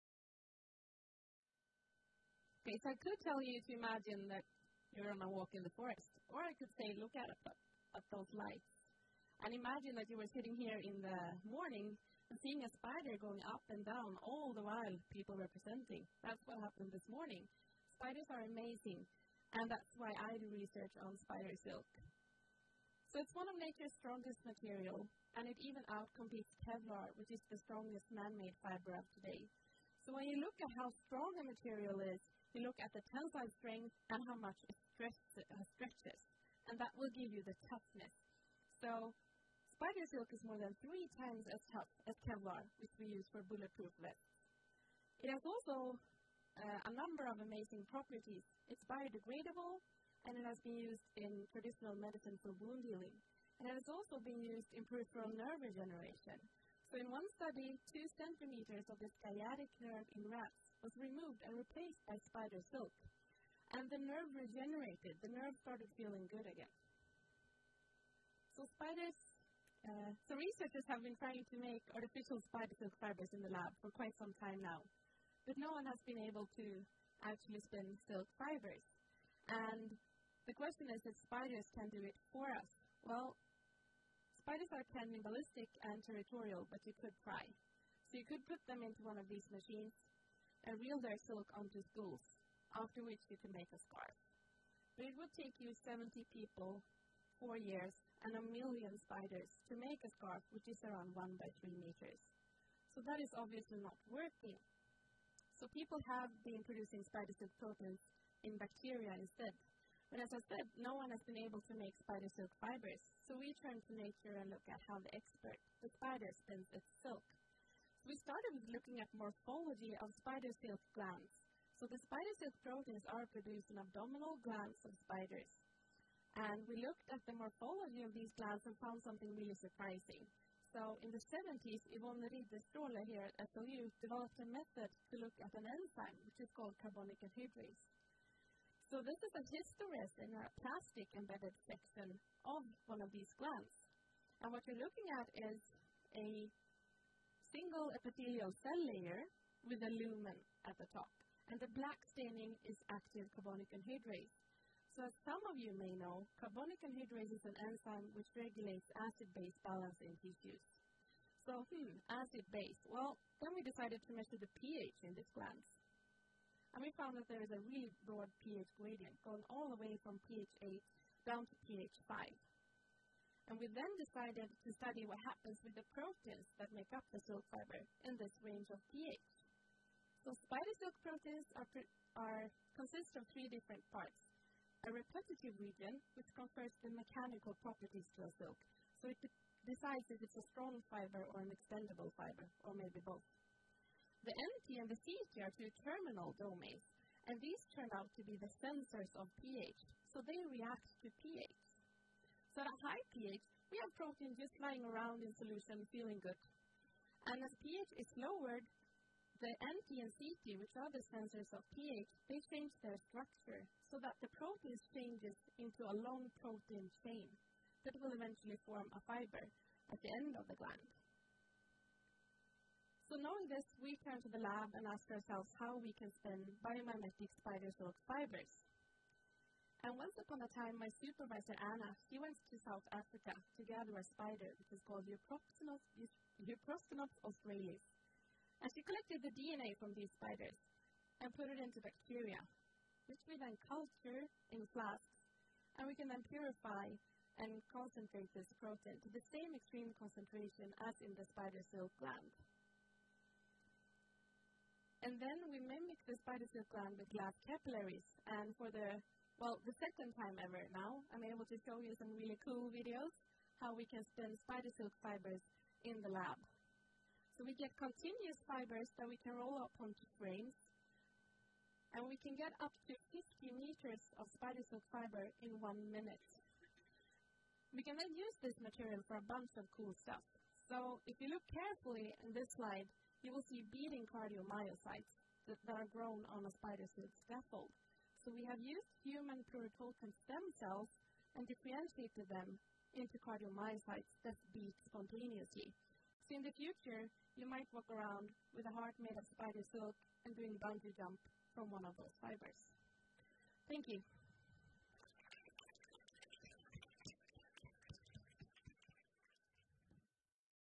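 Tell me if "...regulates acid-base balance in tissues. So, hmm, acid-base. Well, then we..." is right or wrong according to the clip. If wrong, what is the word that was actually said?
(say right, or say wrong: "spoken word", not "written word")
right.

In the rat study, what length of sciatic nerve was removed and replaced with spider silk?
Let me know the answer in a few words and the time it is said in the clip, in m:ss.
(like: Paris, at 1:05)
2 centimeters, at 0:57.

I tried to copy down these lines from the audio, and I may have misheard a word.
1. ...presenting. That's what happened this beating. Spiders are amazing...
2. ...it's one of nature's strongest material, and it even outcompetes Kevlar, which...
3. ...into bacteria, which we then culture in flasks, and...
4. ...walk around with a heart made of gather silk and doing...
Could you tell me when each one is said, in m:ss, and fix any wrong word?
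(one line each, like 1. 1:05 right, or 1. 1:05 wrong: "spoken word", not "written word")
1. 0:15 wrong: "morning", not "beating"
2. 0:23 right
3. 4:01 right
4. 4:57 wrong: "spider", not "gather".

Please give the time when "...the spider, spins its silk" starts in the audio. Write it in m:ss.
1:55.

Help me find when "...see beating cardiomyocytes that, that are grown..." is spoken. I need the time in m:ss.
4:43.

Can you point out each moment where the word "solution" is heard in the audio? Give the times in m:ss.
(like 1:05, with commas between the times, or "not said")
3:25.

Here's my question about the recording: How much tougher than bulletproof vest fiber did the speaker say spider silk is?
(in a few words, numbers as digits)
more than 3 times.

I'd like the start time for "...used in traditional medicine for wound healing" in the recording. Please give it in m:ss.
0:50.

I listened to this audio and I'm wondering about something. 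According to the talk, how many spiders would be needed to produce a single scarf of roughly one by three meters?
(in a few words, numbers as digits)
a million.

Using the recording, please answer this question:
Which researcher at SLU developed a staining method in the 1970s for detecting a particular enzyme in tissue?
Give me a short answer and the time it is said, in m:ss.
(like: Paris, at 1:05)
Yvonne Ridderstråle, at 2:11.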